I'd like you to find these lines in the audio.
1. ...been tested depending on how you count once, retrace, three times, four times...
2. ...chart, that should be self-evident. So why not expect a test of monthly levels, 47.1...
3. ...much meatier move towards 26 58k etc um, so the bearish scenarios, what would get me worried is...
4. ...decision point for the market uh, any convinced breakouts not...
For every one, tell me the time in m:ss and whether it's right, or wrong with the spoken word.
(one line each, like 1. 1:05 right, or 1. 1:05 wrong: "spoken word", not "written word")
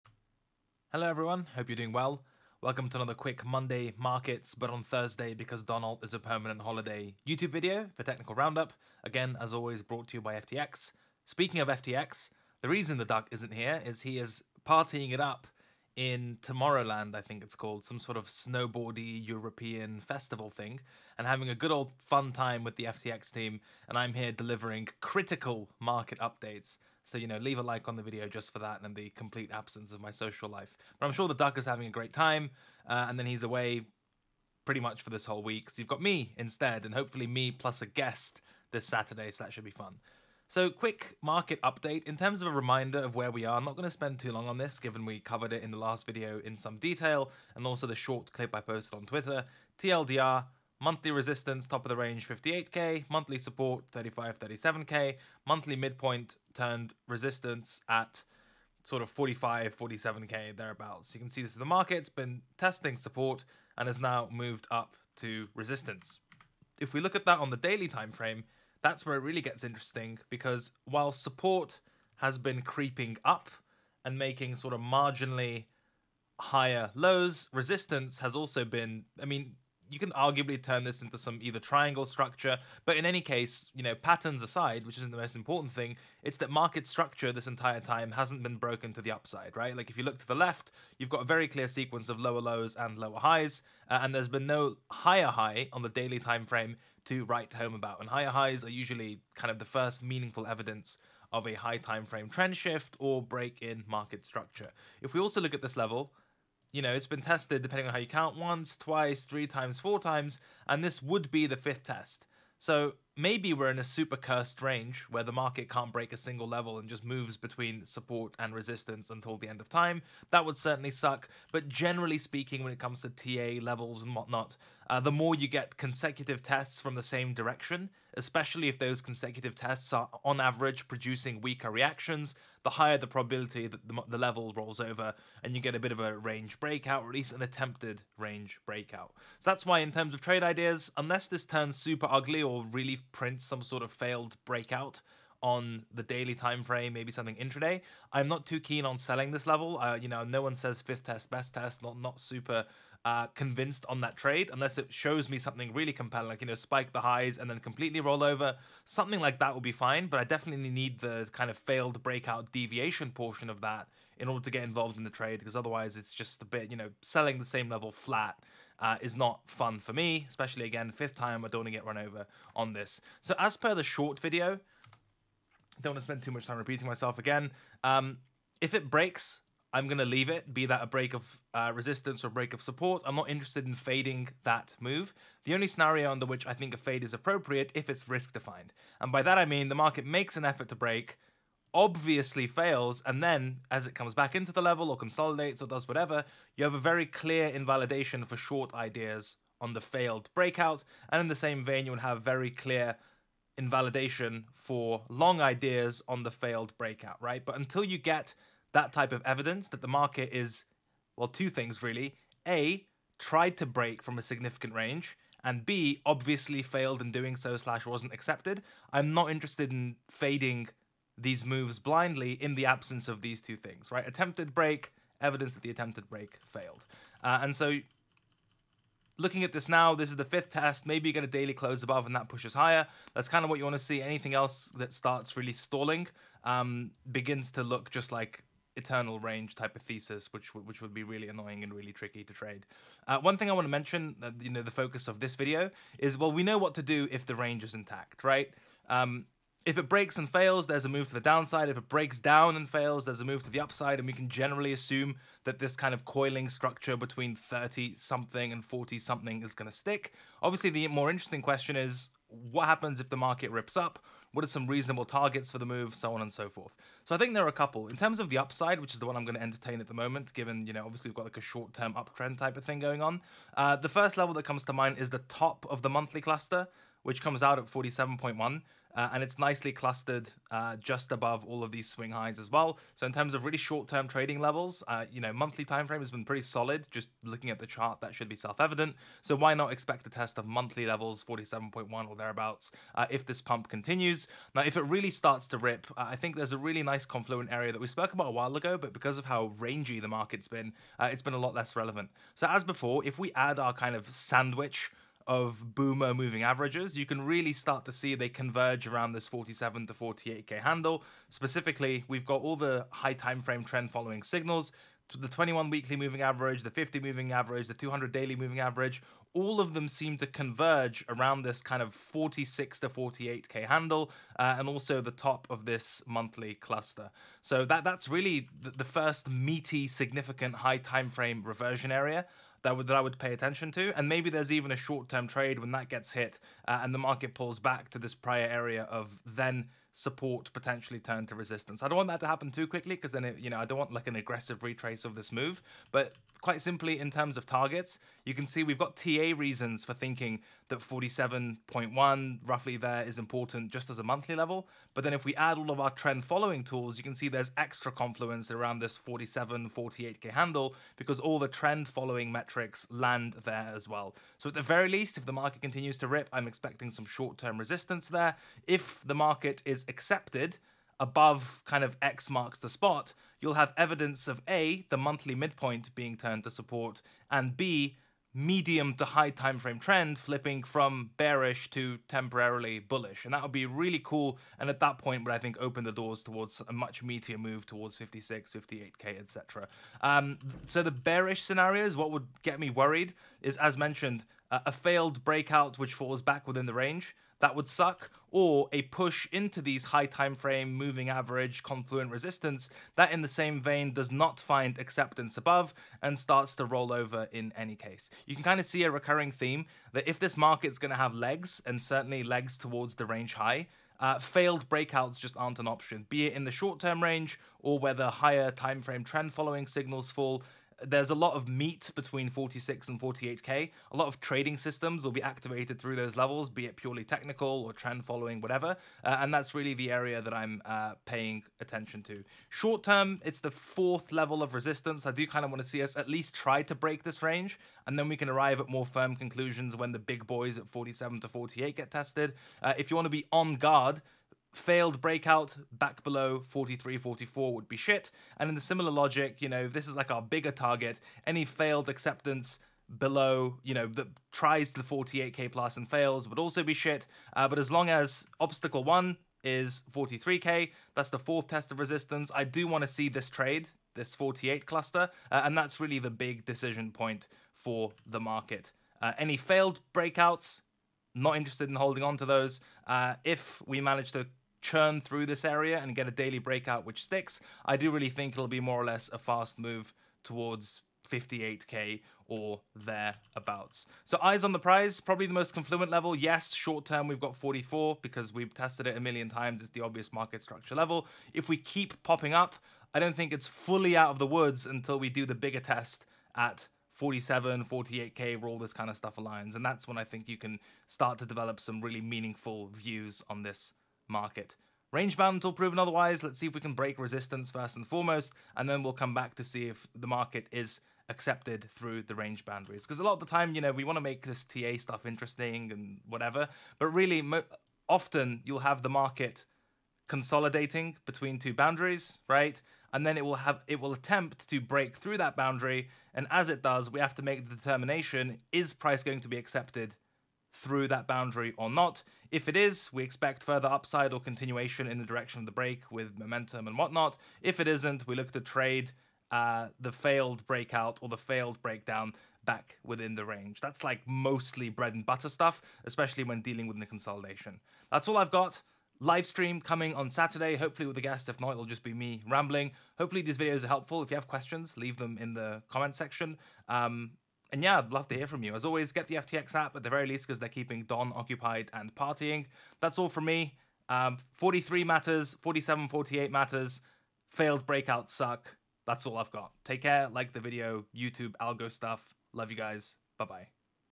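1. 1:47 wrong: "twice", not "retrace"
2. 4:47 right
3. 6:26 wrong: "56", not "26"
4. 7:46 wrong: "failed", not "convinced".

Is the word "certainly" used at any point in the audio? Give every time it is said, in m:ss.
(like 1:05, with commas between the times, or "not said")
2:00, 6:51.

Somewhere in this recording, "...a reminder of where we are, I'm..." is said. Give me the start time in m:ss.
0:42.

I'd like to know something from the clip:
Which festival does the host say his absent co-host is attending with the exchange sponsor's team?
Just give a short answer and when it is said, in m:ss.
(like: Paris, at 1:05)
Tomorrowland, at 0:16.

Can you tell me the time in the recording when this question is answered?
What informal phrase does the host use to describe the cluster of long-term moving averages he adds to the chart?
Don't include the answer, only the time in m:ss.
5:05.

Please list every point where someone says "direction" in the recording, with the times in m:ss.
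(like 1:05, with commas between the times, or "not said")
2:07, 8:55.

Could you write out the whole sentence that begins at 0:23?
And I'm here delivering critical market updates.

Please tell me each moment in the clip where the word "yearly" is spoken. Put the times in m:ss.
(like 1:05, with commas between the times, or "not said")
not said.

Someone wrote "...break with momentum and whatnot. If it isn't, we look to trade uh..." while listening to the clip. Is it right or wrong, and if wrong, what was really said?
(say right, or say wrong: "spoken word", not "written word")
right.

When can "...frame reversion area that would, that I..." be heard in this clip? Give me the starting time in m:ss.
5:31.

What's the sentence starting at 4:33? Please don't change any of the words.
Uh, the first level that comes to mind is the top of the monthly cluster, which comes out at 47.1.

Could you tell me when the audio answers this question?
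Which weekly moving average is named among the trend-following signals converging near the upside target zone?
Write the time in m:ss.
5:15.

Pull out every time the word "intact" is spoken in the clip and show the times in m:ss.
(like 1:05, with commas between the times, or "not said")
4:07.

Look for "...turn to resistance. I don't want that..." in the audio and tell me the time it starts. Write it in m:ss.
5:40.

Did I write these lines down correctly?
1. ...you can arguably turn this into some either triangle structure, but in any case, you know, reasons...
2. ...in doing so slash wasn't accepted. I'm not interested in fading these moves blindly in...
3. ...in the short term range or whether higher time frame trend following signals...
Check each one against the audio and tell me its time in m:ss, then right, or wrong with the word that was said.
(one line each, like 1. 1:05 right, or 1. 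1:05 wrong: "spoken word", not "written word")
1. 1:19 wrong: "patterns", not "reasons"
2. 3:37 right
3. 6:56 right.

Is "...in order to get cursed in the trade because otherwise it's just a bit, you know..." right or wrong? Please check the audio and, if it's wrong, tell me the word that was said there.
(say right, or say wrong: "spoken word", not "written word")
wrong: "involved", not "cursed".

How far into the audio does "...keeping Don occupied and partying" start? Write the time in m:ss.
9:20.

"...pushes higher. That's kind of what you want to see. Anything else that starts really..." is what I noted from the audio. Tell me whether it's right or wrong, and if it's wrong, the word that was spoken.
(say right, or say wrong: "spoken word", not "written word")
right.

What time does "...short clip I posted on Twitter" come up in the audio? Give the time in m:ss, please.
0:47.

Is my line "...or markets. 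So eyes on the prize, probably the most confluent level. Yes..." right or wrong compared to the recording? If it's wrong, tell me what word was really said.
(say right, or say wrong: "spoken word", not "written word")
wrong: "thereabouts", not "markets".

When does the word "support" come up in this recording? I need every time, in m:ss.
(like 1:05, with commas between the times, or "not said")
0:53, 1:02, 1:11, 1:57, 3:02, 5:39, 6:16.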